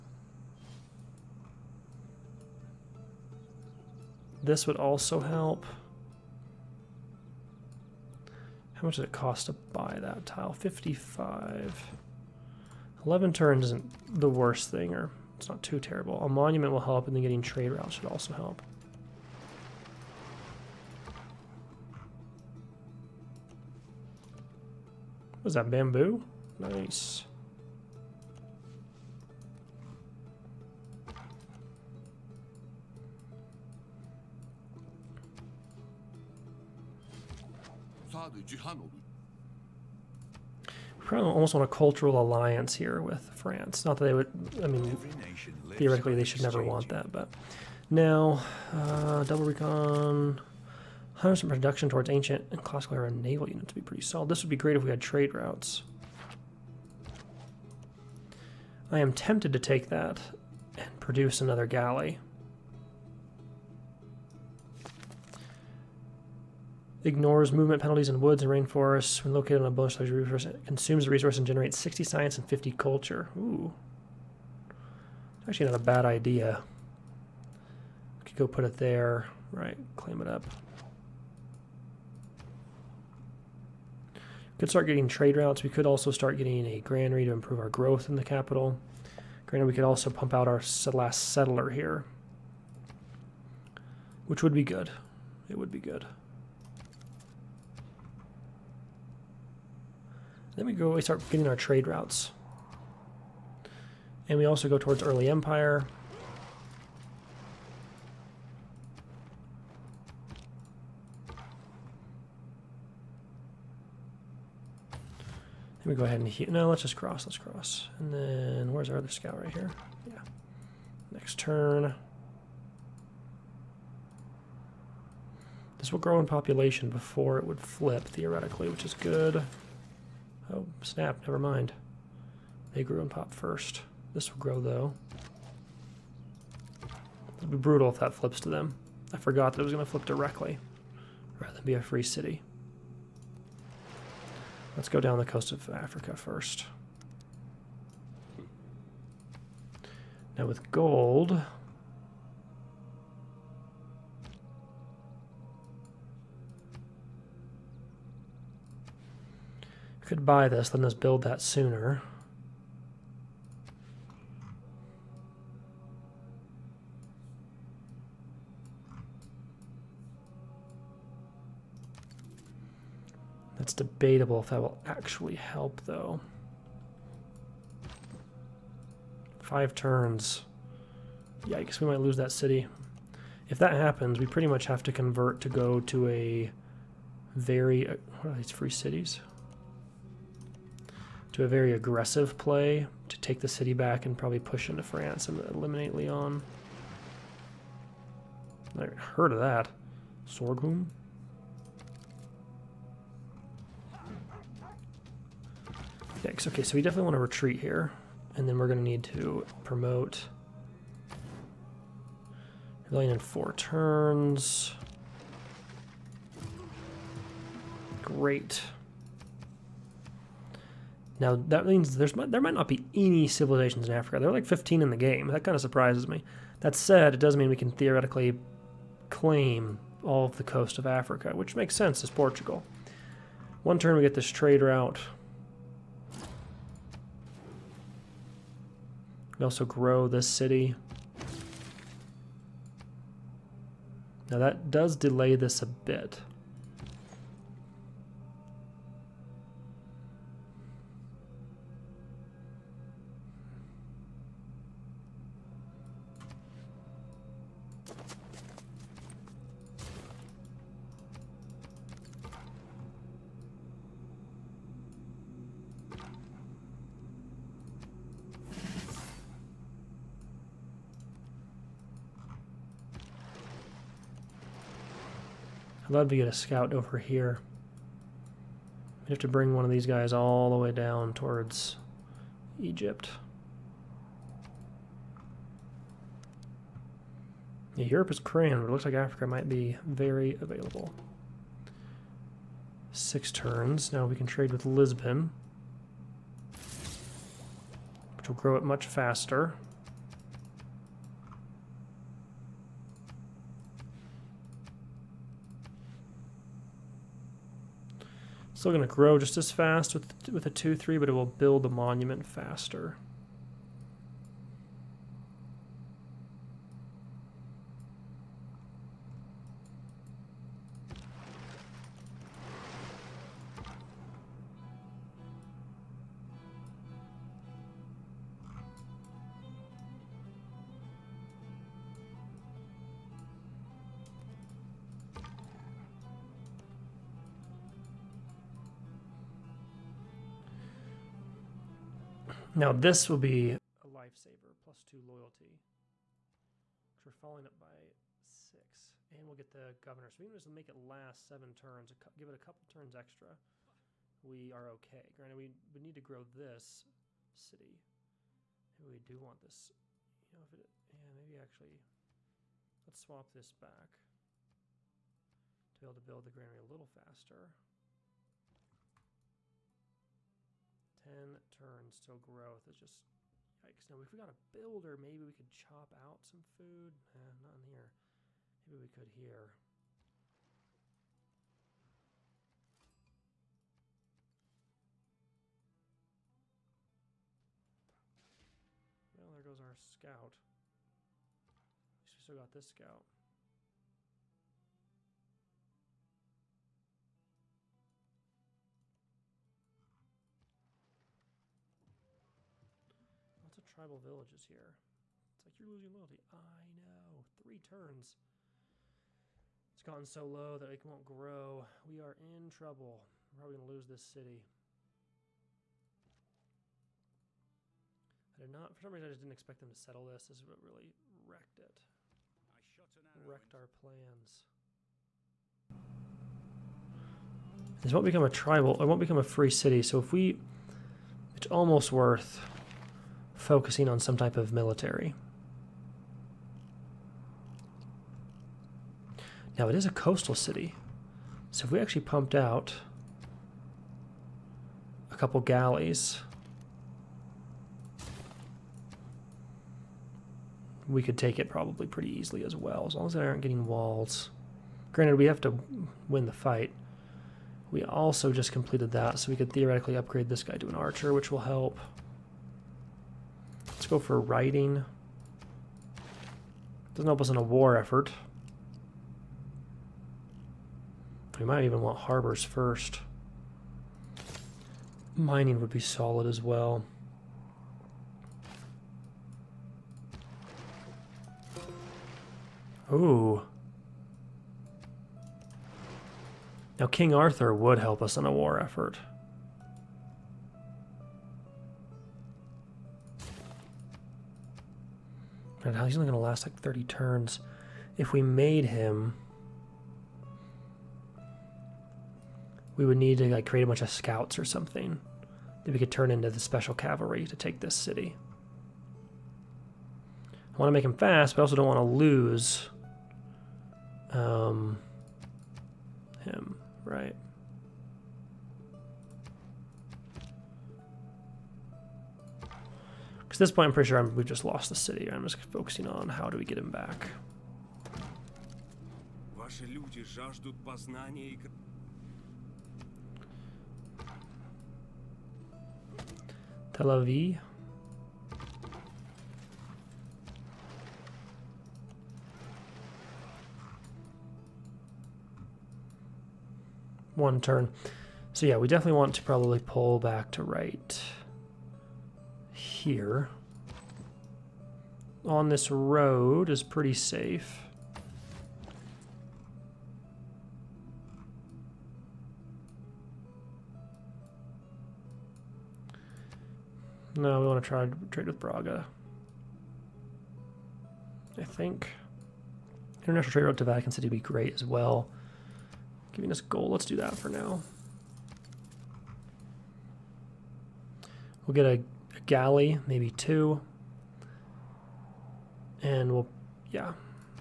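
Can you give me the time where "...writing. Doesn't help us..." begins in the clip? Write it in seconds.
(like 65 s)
464 s.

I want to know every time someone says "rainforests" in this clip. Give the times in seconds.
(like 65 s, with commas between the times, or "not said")
68 s.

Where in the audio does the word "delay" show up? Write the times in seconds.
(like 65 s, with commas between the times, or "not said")
244 s.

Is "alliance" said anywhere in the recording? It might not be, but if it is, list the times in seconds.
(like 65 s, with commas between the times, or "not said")
42 s.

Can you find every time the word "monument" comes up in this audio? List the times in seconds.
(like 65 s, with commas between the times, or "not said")
16 s, 311 s.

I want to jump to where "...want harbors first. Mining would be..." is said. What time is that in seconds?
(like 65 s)
471 s.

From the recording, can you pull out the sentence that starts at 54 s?
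This would be great if we had trade routes.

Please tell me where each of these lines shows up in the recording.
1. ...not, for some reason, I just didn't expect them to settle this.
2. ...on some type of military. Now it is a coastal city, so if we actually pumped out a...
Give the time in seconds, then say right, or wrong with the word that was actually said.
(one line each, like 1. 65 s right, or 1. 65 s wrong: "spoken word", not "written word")
1. 418 s right
2. 433 s right.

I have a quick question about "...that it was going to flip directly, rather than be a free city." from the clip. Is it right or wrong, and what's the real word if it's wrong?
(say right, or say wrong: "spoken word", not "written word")
right.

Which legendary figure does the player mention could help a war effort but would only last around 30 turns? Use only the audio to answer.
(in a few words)
King Arthur.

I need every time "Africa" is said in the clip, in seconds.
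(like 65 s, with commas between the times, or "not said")
145 s, 223 s, 230 s, 288 s.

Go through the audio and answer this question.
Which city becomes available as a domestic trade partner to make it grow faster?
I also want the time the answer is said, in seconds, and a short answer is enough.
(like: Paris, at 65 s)
Lisbon, at 294 s.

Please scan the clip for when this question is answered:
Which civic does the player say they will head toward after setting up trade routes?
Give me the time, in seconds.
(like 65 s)
105 s.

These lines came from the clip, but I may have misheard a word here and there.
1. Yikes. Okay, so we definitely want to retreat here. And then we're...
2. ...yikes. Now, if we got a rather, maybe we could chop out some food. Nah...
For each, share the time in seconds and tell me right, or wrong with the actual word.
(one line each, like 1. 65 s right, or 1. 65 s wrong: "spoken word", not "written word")
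1. 206 s right
2. 373 s wrong: "builder", not "rather".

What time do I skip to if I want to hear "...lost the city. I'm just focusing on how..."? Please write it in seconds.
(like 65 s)
524 s.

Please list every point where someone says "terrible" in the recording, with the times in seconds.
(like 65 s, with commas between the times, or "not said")
15 s.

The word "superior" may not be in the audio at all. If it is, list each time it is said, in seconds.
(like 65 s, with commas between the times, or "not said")
not said.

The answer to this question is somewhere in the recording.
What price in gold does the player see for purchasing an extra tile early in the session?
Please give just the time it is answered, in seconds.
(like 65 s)
10 s.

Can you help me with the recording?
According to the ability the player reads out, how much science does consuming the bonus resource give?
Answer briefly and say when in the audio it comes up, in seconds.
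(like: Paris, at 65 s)
60, at 71 s.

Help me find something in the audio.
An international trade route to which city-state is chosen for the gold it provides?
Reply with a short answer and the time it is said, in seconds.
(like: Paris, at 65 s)
Vatican City, at 573 s.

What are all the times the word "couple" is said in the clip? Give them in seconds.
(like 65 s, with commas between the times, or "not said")
352 s, 445 s.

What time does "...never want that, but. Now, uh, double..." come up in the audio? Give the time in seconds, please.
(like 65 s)
46 s.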